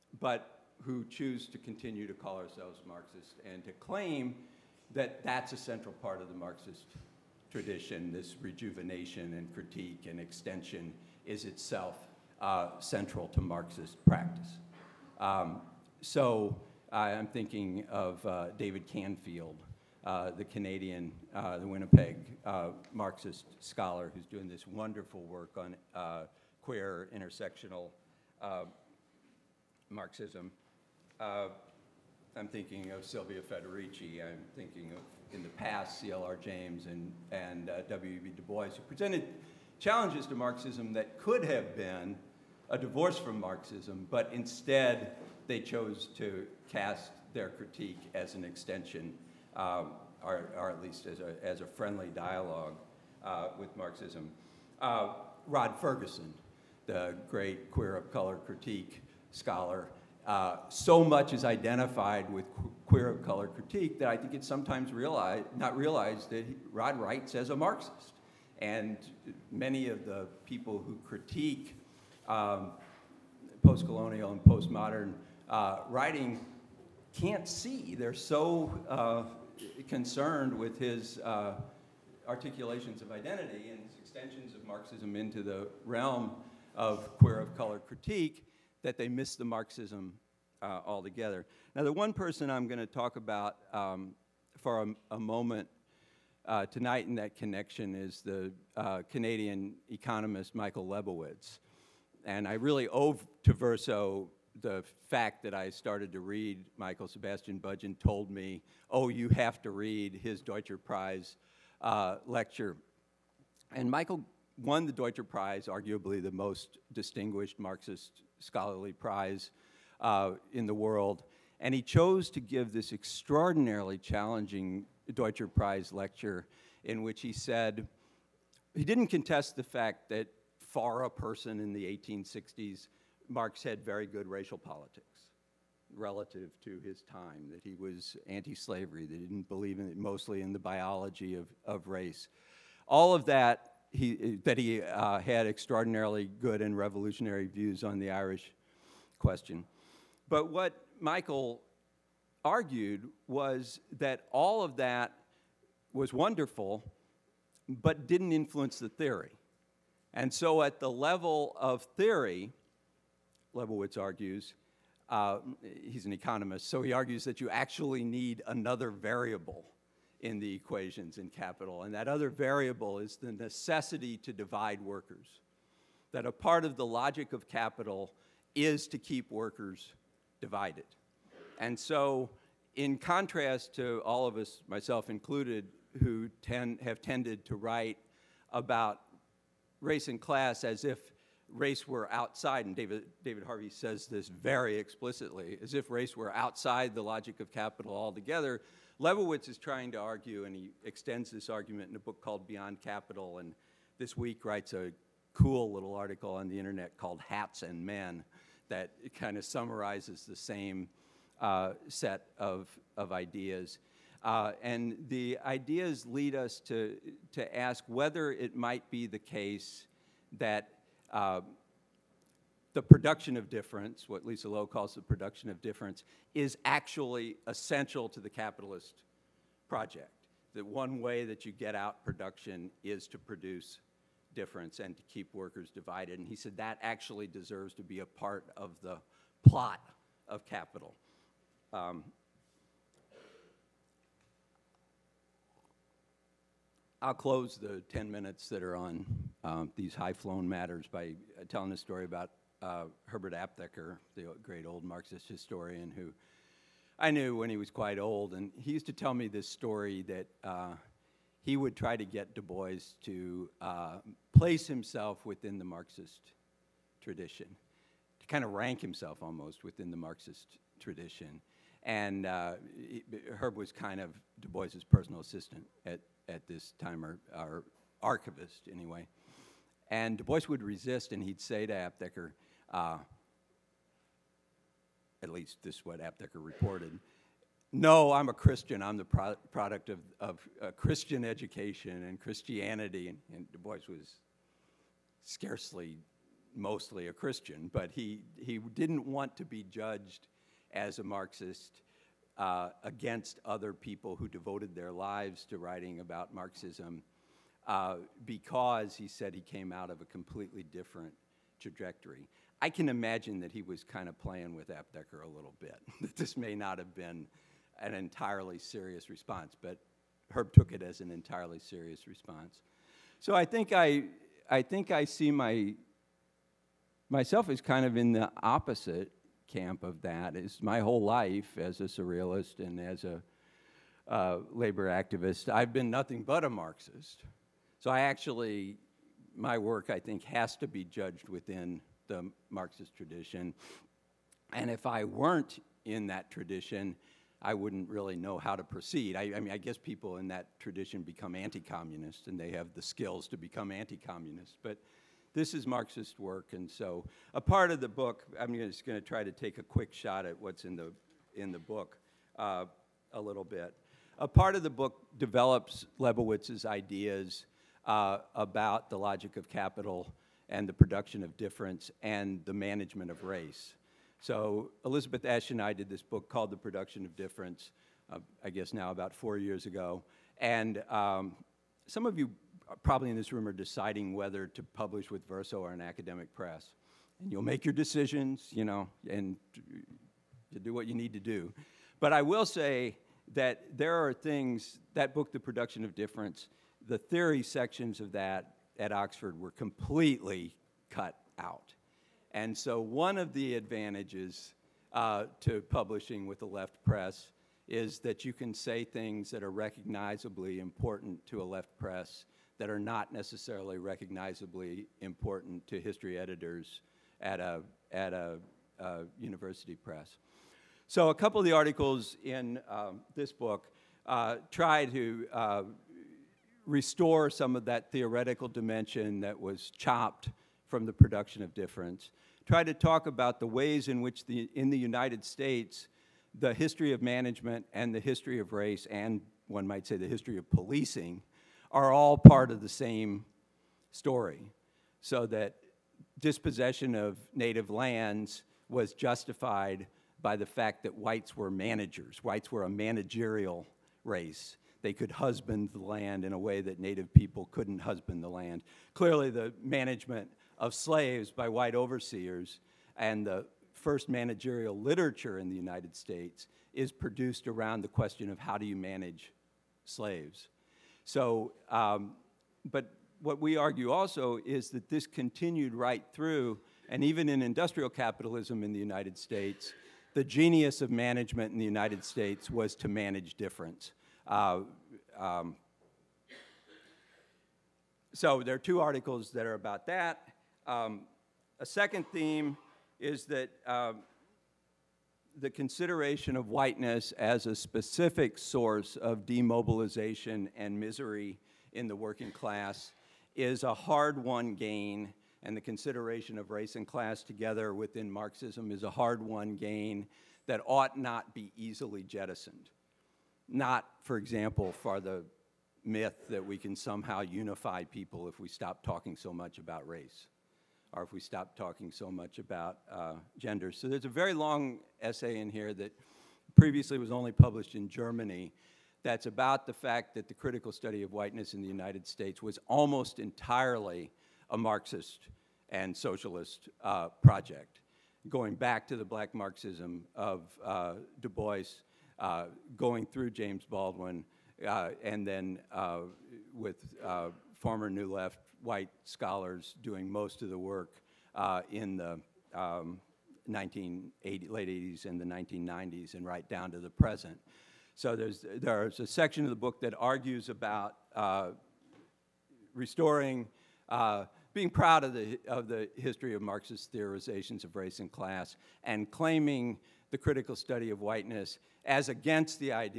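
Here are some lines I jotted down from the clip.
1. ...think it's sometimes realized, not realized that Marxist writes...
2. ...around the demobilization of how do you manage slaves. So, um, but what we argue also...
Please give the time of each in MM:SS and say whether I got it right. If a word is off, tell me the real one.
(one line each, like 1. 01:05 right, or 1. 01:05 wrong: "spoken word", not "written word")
1. 01:04 wrong: "Rod", not "Marxist"
2. 07:47 wrong: "question", not "demobilization".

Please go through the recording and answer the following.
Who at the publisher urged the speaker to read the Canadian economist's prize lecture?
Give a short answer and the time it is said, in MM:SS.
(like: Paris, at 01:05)
Sebastian Budgen, at 01:47.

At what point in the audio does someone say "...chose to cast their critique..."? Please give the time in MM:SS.
00:45.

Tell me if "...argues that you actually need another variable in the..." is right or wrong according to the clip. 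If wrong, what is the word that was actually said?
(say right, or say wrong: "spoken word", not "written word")
right.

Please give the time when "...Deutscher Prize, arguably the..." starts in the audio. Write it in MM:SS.
01:54.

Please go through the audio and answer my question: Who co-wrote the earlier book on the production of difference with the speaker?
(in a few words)
Elizabeth Esch.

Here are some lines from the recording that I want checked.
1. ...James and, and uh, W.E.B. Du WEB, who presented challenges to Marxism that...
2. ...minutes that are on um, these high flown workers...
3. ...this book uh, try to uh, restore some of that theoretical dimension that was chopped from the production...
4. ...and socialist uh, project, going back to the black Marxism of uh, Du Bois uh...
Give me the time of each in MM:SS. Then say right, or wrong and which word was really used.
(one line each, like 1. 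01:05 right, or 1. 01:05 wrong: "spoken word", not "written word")
1. 00:36 wrong: "Bois", not "WEB"
2. 04:08 wrong: "matters", not "workers"
3. 07:03 right
4. 08:55 right.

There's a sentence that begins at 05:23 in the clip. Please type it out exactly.
So I think I, I think I see my, myself as kind of in the opposite camp of that.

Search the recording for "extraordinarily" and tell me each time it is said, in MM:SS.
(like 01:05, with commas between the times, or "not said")
02:02, 02:25.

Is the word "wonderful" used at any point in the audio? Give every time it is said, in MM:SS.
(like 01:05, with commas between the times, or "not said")
00:24, 02:36.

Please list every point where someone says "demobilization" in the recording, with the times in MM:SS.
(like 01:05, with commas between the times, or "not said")
08:19.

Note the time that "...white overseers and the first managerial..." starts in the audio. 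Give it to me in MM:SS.
07:41.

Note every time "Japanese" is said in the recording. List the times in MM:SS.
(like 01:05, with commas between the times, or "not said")
not said.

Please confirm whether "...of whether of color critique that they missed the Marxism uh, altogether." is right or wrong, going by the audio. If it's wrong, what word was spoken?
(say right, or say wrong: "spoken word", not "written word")
wrong: "queer", not "whether".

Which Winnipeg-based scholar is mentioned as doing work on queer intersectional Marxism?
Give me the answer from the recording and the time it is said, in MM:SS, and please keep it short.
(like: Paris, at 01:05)
David Canfield, at 00:18.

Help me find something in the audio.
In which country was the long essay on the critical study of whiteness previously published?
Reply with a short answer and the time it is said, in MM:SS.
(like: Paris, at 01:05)
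Germany, at 08:47.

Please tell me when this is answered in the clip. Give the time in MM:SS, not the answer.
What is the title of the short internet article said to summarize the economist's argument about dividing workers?
03:27.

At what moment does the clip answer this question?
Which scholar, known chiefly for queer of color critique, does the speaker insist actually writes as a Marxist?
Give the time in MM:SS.
00:55.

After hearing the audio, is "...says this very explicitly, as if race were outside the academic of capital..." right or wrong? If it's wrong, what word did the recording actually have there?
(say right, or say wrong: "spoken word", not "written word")
wrong: "logic", not "academic".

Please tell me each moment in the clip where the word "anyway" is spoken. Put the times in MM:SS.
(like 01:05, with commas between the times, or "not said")
04:38.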